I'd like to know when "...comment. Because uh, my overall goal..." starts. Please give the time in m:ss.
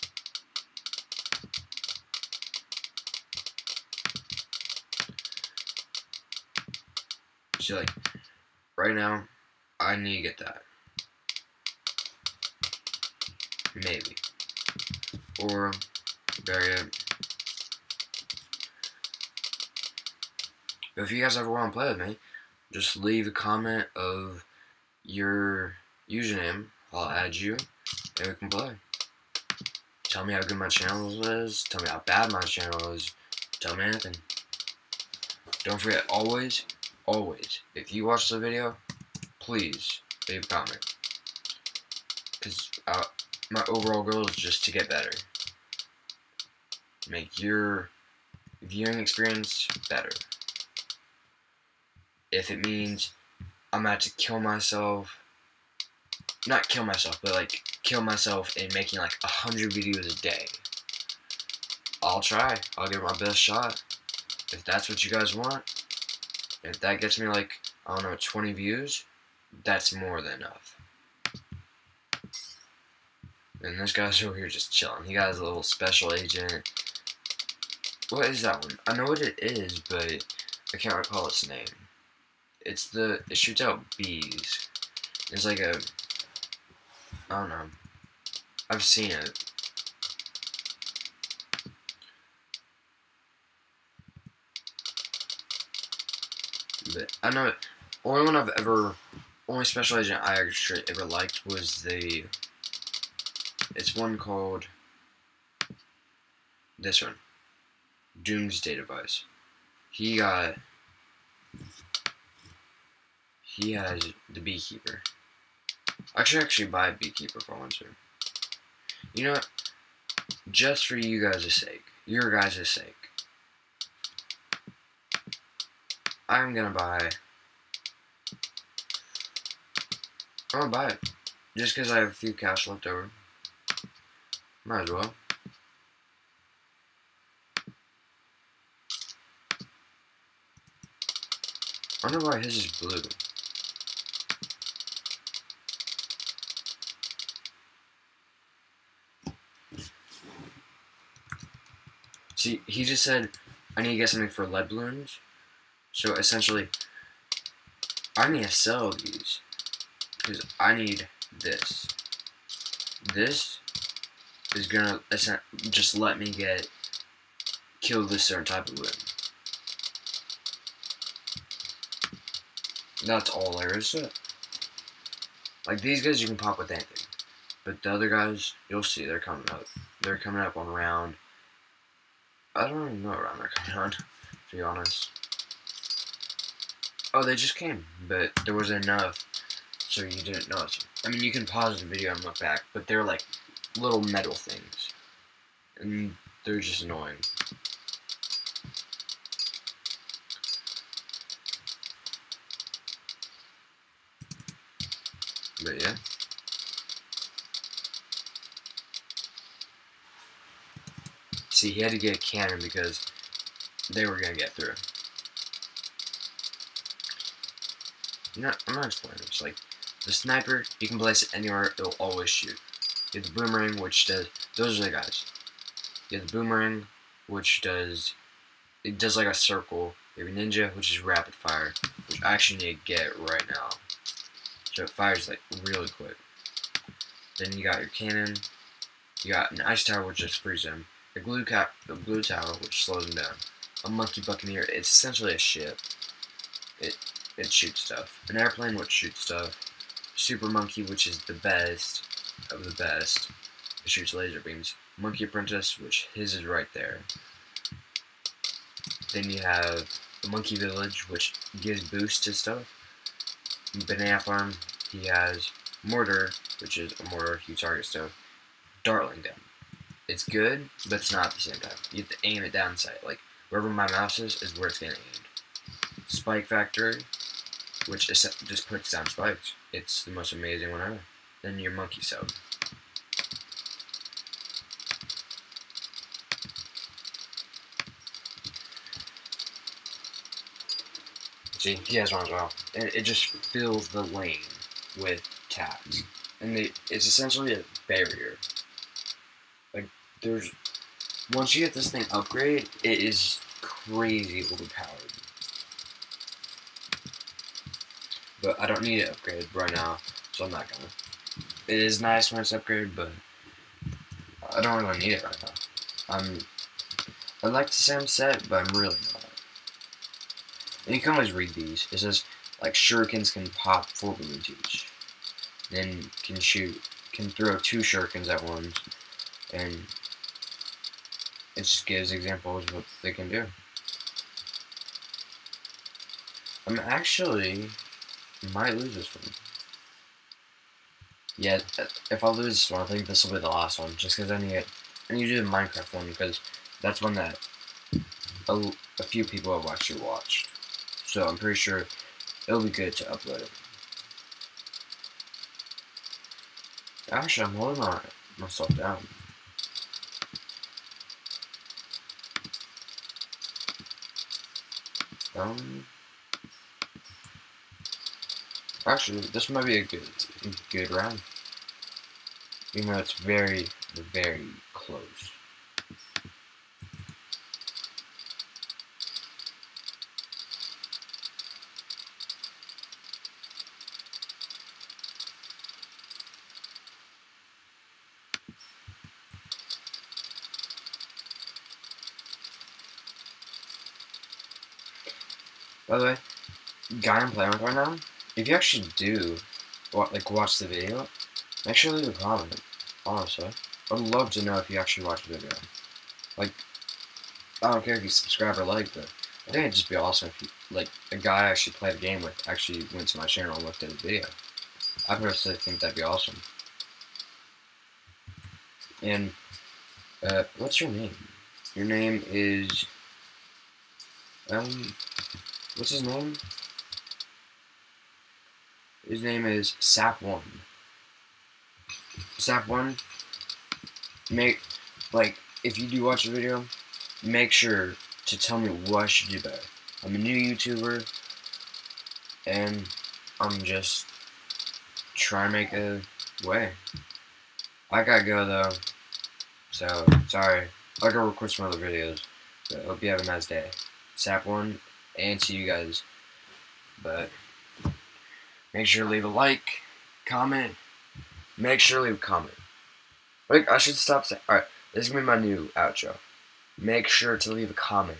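0:40.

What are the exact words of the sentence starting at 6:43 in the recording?
I'd love to know if you actually watch the video.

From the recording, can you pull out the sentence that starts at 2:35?
So essentially, I need to sell these.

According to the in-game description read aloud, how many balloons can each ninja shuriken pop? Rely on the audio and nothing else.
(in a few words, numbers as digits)
4.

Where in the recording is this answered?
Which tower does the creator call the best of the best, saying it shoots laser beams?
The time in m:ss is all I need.
4:10.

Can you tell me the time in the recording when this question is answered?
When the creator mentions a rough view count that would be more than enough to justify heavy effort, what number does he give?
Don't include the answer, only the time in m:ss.
1:08.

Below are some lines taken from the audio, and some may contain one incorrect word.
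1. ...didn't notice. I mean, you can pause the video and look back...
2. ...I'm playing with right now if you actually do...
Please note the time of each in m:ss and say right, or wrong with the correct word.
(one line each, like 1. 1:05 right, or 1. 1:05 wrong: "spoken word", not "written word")
1. 3:10 right
2. 6:37 right.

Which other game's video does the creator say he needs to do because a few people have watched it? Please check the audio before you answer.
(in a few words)
Minecraft.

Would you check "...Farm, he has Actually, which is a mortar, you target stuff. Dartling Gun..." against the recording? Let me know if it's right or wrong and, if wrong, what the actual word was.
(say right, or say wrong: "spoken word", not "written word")
wrong: "Mortar", not "Actually".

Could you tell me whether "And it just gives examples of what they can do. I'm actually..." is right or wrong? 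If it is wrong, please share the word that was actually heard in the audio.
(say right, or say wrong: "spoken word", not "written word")
right.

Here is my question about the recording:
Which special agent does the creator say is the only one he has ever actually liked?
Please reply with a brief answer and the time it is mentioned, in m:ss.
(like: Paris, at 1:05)
Doomsday Device, at 1:48.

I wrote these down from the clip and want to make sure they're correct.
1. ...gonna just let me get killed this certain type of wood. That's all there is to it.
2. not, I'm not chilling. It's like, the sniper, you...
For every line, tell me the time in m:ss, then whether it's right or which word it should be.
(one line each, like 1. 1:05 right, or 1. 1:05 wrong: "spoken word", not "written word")
1. 2:44 right
2. 3:38 wrong: "explaining", not "chilling".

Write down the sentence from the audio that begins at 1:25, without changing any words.
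It's like a, I don't know.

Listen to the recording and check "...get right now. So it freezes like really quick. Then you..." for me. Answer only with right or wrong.
wrong.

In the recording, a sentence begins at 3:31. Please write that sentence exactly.
See, he had to get a cannon because they were going to get through.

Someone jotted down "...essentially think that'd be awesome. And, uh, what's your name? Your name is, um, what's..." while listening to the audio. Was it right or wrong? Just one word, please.
wrong.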